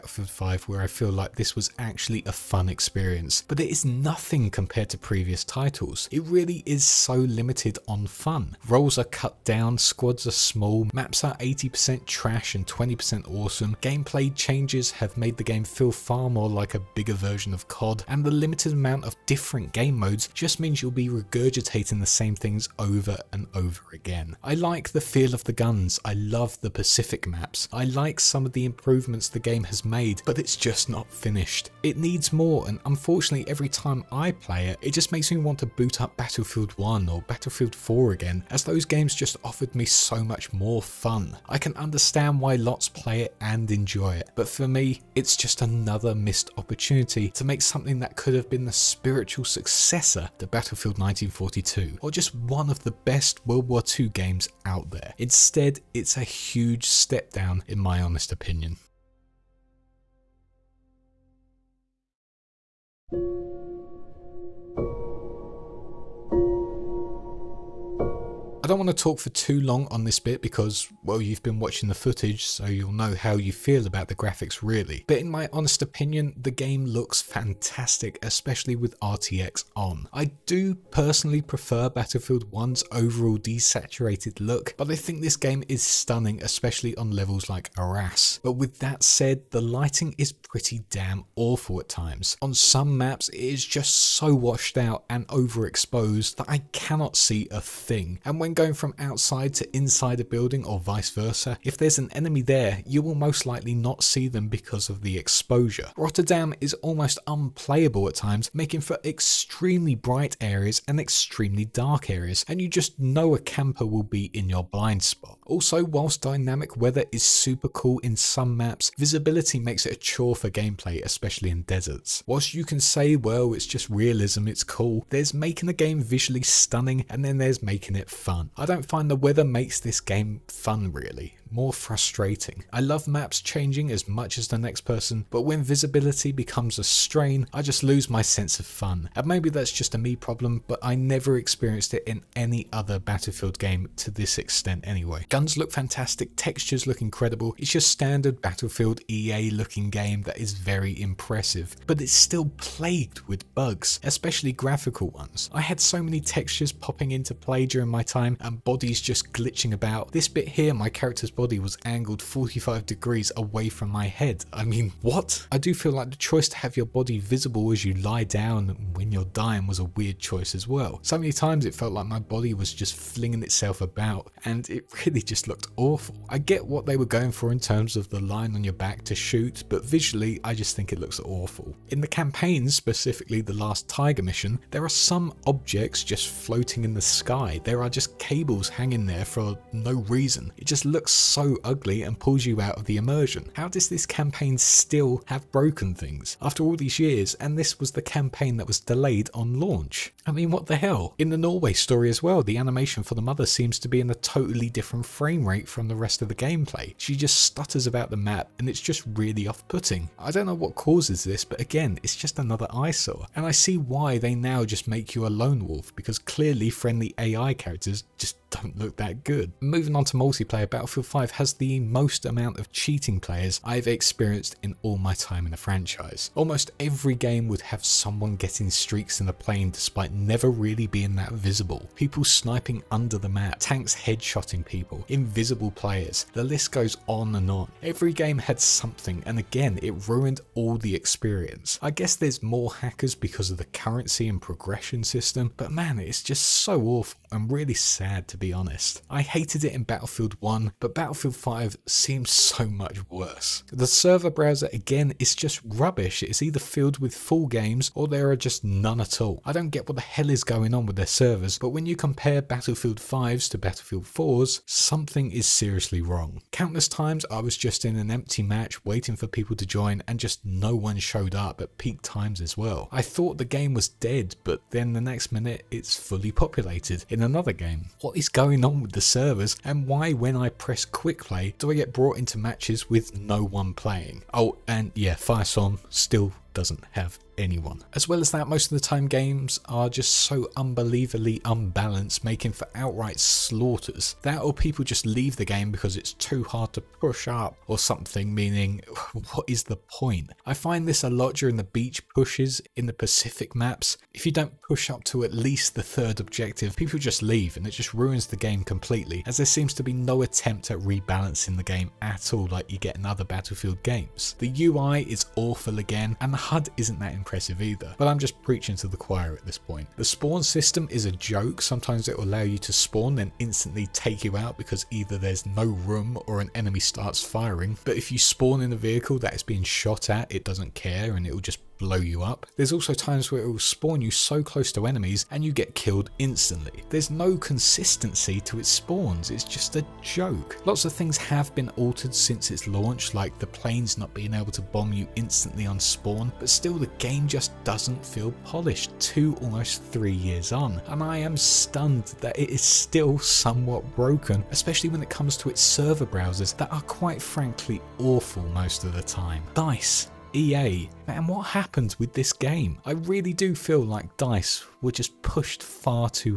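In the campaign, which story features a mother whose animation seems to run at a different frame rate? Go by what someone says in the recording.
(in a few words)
Norway.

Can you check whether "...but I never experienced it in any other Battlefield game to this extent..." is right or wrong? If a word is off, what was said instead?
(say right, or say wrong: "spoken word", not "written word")
right.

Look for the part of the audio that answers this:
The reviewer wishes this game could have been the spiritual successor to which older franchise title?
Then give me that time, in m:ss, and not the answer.
0:50.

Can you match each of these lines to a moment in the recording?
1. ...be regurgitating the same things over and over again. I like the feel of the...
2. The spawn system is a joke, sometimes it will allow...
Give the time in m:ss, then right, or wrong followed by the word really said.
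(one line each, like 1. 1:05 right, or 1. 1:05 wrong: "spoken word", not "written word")
1. 0:20 right
2. 5:19 right.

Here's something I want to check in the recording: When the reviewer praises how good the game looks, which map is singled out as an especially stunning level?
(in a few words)
Arras.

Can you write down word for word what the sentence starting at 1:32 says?
On some maps, it is just so washed out and overexposed that I cannot see a thing.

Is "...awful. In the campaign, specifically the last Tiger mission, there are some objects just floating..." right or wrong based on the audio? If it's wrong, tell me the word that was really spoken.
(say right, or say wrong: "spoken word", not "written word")
right.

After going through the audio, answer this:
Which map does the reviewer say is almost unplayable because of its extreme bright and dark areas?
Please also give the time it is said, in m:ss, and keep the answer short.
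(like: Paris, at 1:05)
Rotterdam, at 1:45.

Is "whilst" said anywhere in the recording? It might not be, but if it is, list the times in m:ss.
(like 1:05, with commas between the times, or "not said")
1:55, 2:02.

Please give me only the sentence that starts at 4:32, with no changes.
I thought the game was dead, but then the next minute it's fully populated in another game.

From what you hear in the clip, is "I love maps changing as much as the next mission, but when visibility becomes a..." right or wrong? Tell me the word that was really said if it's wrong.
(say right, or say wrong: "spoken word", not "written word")
wrong: "person", not "mission".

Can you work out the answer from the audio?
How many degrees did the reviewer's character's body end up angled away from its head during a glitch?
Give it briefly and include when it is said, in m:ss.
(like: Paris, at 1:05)
45, at 2:42.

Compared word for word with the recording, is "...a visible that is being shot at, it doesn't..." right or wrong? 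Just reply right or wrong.
wrong.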